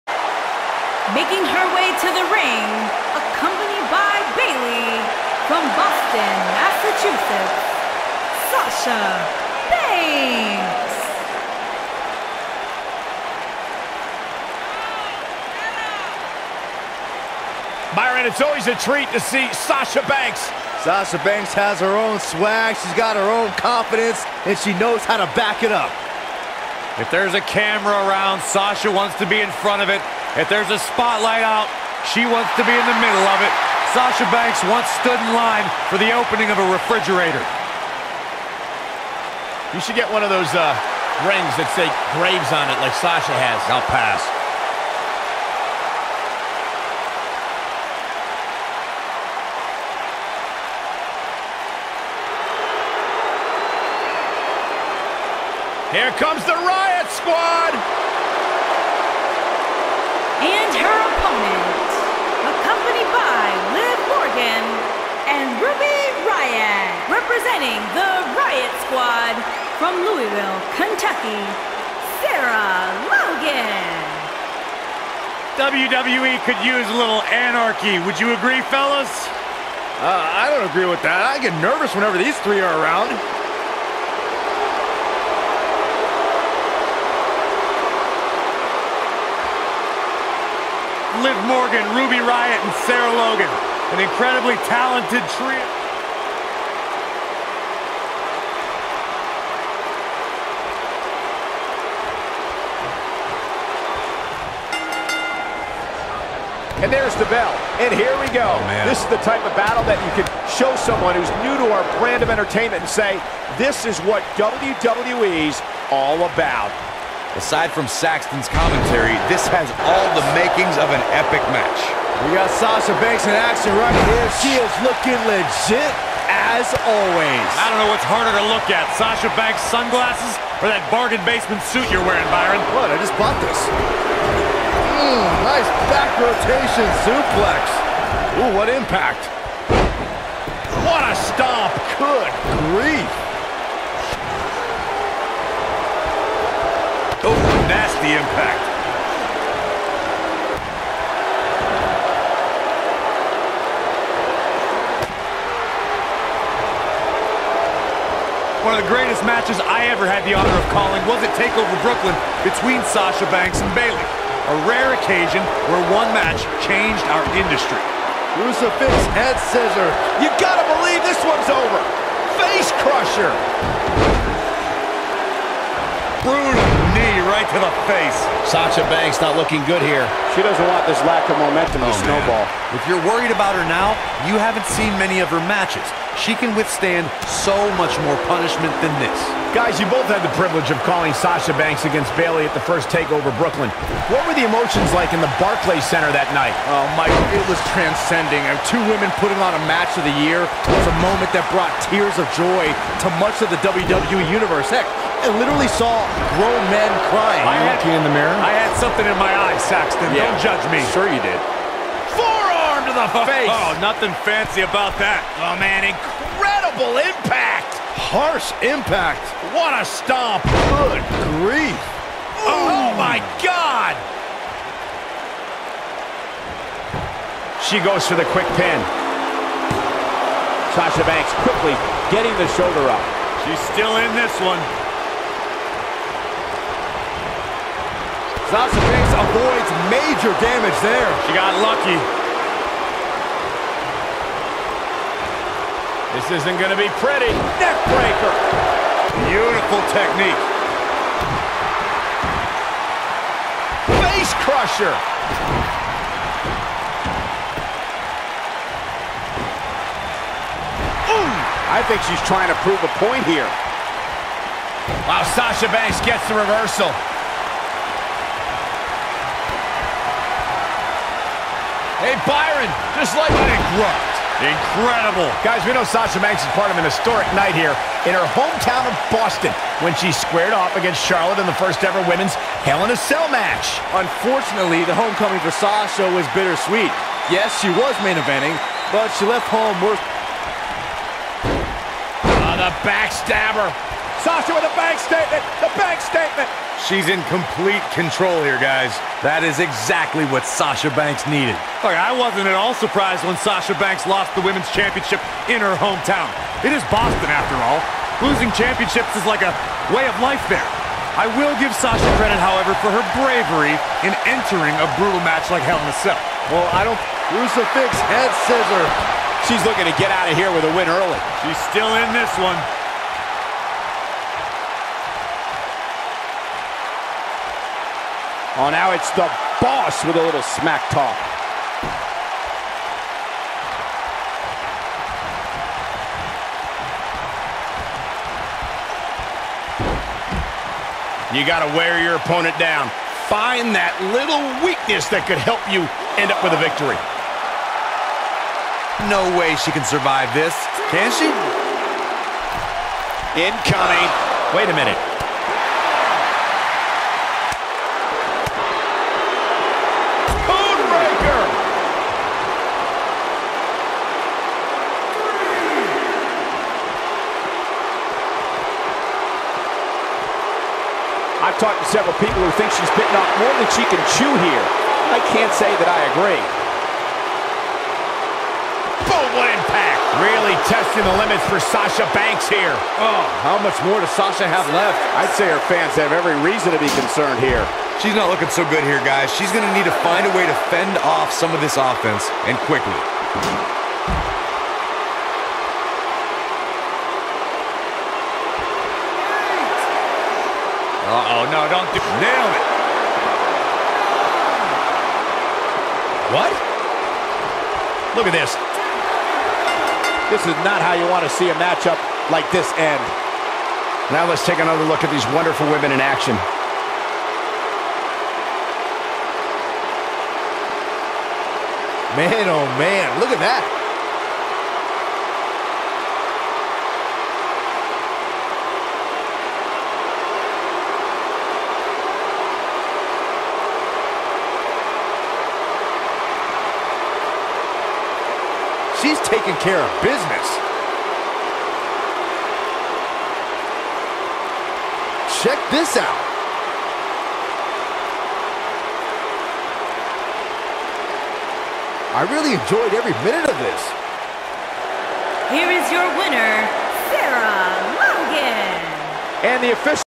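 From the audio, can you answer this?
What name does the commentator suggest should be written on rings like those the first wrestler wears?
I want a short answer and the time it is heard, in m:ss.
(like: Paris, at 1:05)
Graves, at 0:42.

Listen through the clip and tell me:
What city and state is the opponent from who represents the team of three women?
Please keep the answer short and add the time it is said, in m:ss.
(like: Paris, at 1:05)
Louisville, Kentucky, at 1:10.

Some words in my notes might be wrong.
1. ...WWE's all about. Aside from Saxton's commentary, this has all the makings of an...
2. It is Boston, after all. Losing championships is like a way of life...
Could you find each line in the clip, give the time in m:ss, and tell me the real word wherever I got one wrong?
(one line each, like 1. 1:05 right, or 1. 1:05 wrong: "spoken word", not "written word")
1. 1:54 right
2. 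5:06 right.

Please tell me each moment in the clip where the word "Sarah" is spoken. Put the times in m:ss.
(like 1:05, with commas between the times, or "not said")
1:12, 1:32, 7:37.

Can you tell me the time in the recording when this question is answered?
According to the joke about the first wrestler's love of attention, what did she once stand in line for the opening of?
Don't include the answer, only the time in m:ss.
0:36.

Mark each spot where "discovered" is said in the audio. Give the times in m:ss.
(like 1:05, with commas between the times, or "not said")
not said.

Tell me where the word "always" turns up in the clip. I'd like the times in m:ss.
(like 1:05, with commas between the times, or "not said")
0:18, 2:06.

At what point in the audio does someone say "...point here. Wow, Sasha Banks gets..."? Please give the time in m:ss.
4:22.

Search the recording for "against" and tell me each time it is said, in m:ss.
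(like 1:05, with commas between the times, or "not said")
3:11, 4:40.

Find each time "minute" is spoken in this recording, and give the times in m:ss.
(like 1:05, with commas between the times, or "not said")
5:54, 7:33.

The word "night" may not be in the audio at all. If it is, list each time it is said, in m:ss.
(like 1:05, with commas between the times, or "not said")
3:16, 4:37.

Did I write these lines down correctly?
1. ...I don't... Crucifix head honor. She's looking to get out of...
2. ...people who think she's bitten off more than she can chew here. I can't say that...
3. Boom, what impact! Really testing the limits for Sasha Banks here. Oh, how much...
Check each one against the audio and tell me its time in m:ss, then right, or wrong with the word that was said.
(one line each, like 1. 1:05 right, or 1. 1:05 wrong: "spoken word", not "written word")
1. 5:16 wrong: "scissor", not "honor"
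2. 6:12 right
3. 6:19 right.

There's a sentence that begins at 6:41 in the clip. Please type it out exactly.
Uh-oh, no, don't do Nail it.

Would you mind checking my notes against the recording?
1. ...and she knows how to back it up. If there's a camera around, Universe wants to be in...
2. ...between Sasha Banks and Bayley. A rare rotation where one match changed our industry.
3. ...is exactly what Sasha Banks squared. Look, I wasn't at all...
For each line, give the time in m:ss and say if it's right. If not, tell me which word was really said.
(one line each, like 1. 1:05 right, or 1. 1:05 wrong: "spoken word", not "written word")
1. 0:24 wrong: "Sasha", not "Universe"
2. 2:42 wrong: "occasion", not "rotation"
3. 4:59 wrong: "needed", not "squared".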